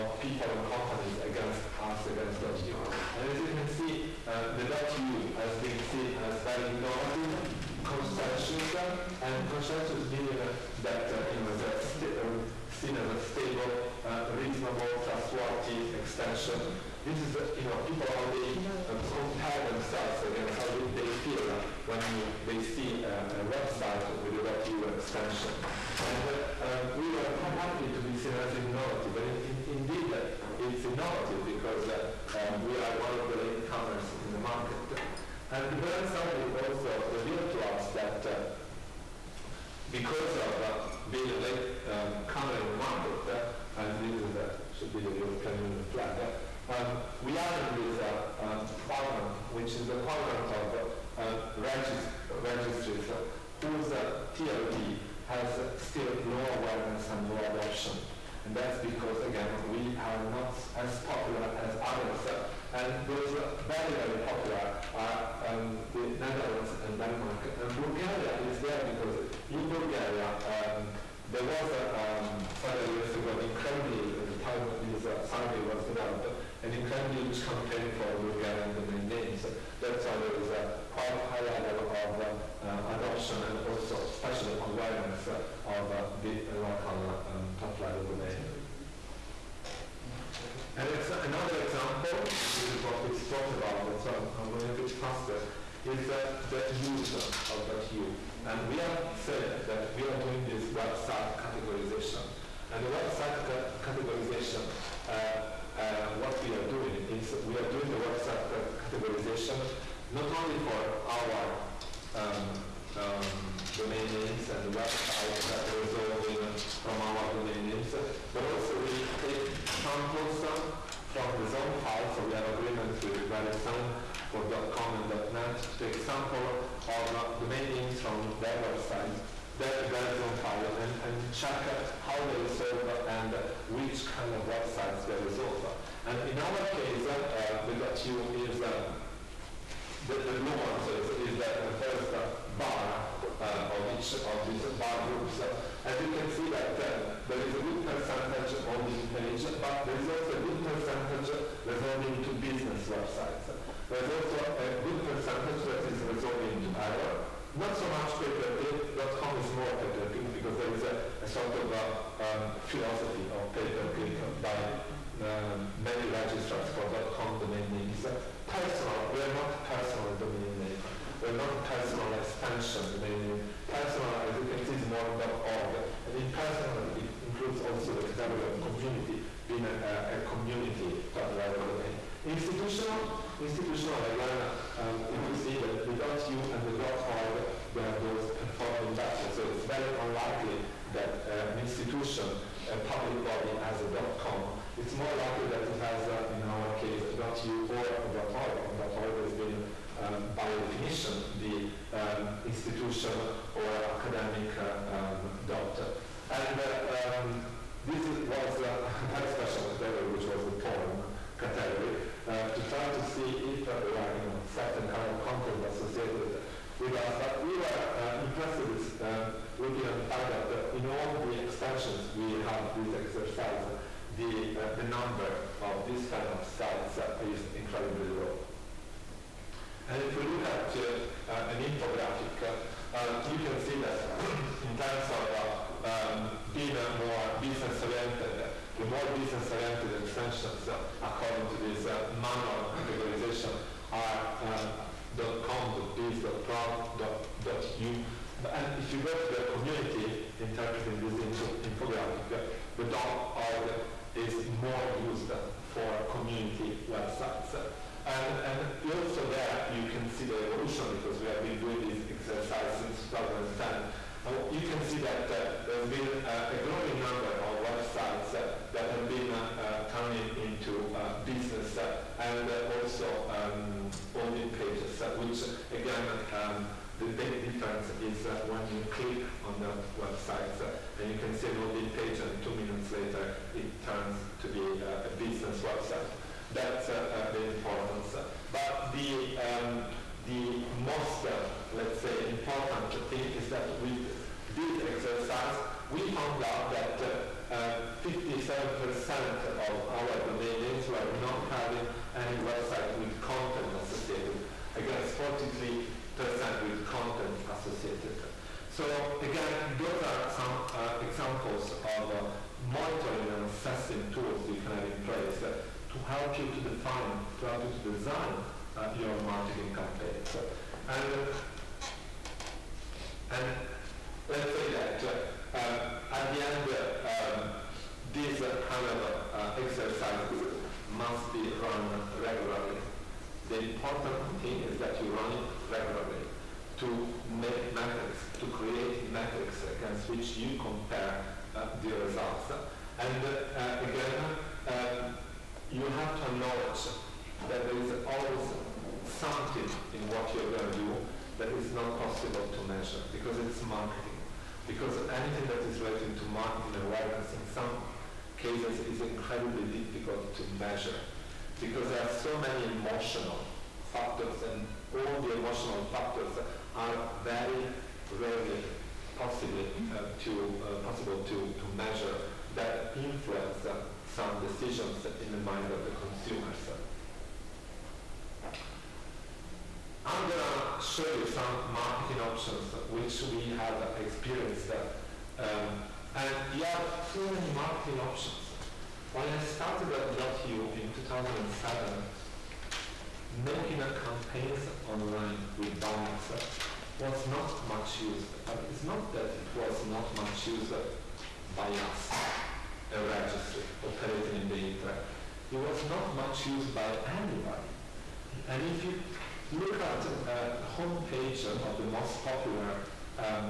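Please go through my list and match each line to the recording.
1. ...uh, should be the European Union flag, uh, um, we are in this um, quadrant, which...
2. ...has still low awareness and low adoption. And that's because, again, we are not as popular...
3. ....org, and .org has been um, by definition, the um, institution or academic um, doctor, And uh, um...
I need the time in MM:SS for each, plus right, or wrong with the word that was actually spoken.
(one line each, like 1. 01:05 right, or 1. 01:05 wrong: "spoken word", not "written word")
1. 00:44 right
2. 00:55 right
3. 03:18 right.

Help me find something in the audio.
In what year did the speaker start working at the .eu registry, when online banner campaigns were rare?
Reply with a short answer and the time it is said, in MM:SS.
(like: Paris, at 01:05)
2007, at 06:31.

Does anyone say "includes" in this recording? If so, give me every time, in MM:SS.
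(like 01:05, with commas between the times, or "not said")
02:57.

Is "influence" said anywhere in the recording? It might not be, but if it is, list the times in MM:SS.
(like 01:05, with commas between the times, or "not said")
06:12.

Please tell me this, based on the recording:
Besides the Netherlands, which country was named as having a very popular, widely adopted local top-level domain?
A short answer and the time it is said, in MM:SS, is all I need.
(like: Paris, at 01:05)
Denmark, at 01:06.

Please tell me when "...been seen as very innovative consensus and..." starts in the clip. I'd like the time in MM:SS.
00:05.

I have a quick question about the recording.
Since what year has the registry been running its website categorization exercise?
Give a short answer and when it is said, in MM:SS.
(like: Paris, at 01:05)
2010, at 04:23.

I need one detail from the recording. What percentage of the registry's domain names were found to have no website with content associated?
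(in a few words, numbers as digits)
57%.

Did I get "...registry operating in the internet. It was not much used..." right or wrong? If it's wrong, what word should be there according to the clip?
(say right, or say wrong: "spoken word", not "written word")
right.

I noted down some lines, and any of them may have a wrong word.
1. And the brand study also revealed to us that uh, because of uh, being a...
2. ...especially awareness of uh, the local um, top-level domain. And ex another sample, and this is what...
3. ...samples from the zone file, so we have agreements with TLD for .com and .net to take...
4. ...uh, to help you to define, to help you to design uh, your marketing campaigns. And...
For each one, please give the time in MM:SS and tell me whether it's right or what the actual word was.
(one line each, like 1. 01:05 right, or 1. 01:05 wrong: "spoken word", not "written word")
1. 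00:35 right
2. 01:24 wrong: "example", not "sample"
3. 01:59 wrong: "VeriSign", not "TLD"
4. 05:15 right.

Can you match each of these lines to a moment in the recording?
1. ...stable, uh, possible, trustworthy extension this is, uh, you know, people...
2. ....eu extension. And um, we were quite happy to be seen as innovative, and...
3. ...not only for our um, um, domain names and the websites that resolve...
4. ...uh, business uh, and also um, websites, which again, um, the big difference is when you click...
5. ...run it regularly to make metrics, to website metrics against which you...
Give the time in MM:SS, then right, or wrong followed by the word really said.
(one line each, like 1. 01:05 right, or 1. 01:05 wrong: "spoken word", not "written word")
1. 00:13 wrong: "reasonable", not "possible"
2. 00:24 right
3. 01:50 right
4. 04:30 wrong: "pages", not "websites"
5. 05:35 wrong: "create", not "website".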